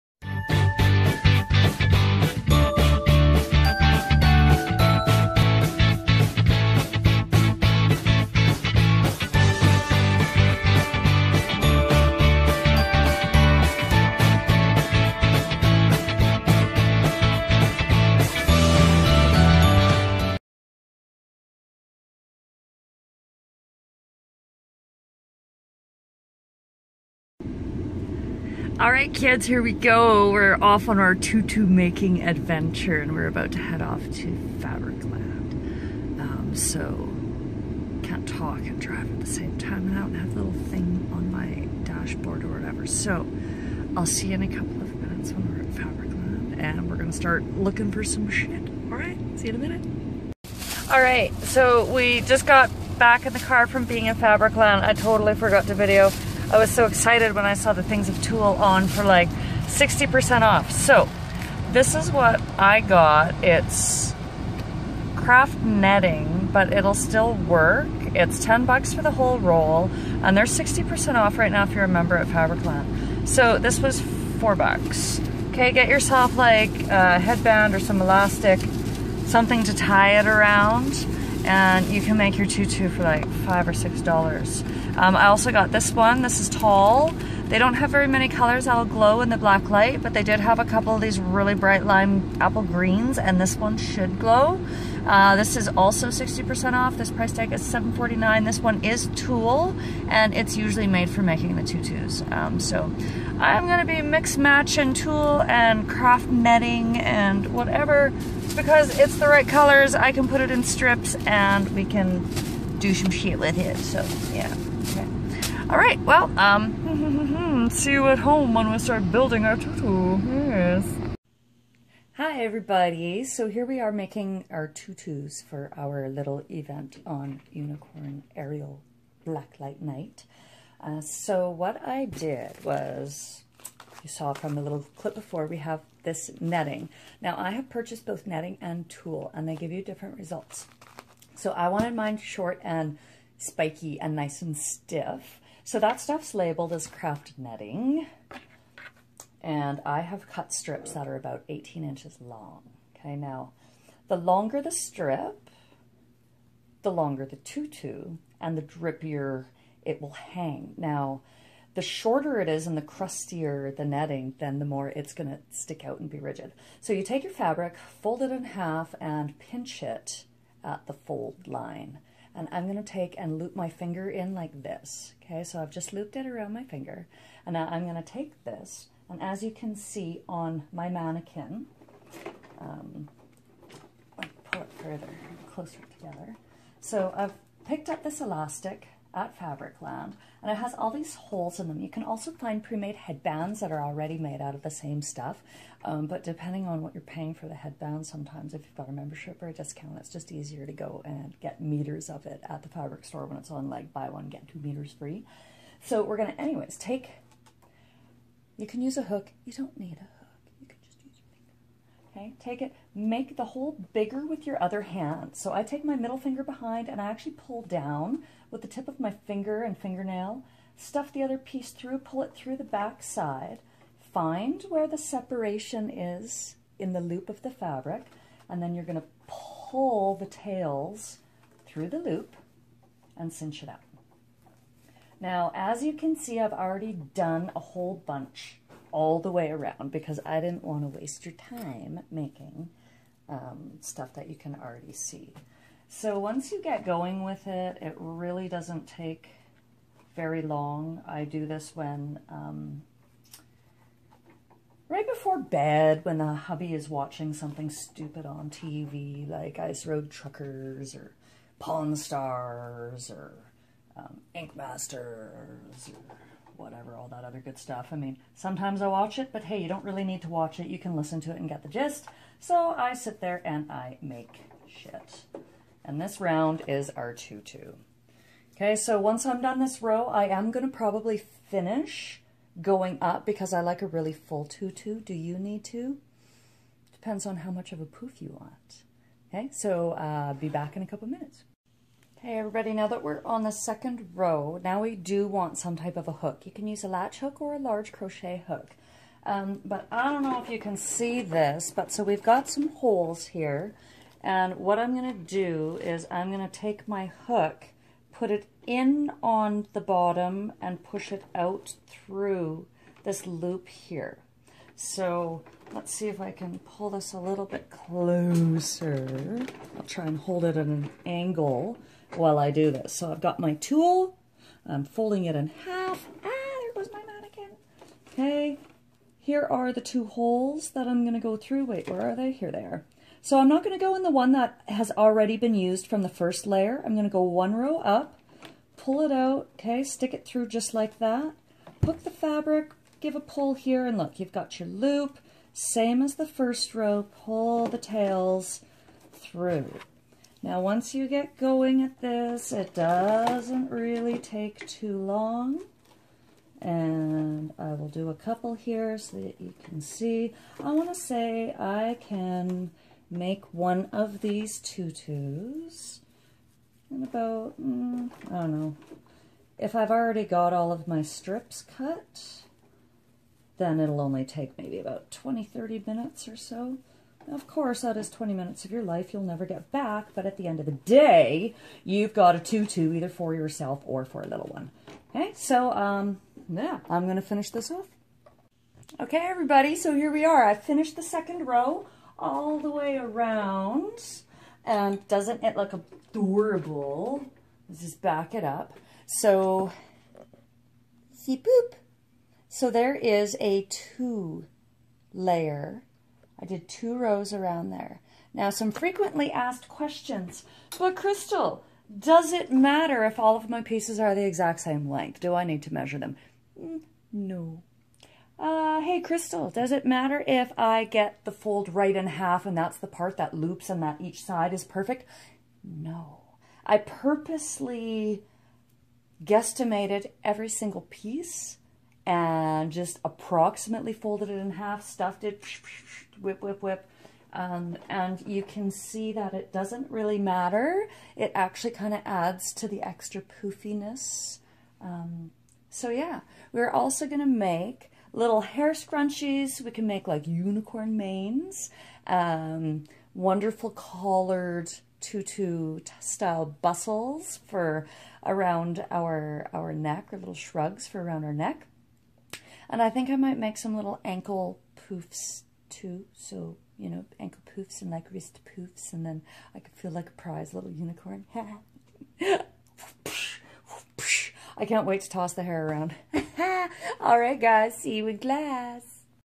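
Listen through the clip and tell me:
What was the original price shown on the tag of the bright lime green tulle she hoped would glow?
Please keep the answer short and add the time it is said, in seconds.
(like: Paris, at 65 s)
$7.49, at 97 s.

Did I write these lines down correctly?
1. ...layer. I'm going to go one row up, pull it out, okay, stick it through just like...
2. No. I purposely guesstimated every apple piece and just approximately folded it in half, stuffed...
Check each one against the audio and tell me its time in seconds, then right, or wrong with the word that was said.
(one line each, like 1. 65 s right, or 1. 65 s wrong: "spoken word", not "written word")
1. 336 s right
2. 425 s wrong: "single", not "apple".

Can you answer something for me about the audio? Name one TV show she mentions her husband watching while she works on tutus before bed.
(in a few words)
Ice Road Truckers.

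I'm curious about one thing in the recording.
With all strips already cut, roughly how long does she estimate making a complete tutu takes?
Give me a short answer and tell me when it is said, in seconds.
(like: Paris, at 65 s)
20 to 30 minutes, at 375 s.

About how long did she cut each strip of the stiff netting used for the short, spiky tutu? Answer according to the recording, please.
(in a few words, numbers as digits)
18 inches.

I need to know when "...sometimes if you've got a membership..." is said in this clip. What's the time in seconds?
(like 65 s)
198 s.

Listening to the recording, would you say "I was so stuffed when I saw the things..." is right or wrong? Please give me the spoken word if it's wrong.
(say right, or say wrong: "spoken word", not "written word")
wrong: "excited", not "stuffed".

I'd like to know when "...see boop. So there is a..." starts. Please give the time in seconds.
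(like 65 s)
401 s.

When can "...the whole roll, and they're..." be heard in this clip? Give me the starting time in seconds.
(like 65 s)
69 s.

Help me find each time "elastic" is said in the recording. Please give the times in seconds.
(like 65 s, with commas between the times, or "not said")
78 s, 188 s.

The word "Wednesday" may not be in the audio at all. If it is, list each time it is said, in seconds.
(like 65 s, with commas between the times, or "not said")
not said.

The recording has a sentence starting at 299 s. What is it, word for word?
Um, but I don't know if you can see this, but so we've got some holes here.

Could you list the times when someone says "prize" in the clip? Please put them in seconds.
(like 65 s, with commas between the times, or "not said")
470 s.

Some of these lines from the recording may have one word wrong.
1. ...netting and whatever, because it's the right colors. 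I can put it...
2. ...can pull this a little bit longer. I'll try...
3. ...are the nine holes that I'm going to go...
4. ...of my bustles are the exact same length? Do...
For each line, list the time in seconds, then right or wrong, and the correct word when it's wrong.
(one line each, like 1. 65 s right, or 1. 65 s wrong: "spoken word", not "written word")
1. 106 s right
2. 316 s wrong: "closer", not "longer"
3. 329 s wrong: "two", not "nine"
4. 413 s wrong: "pieces", not "bustles".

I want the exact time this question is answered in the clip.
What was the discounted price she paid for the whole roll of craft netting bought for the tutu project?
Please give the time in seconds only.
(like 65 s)
74 s.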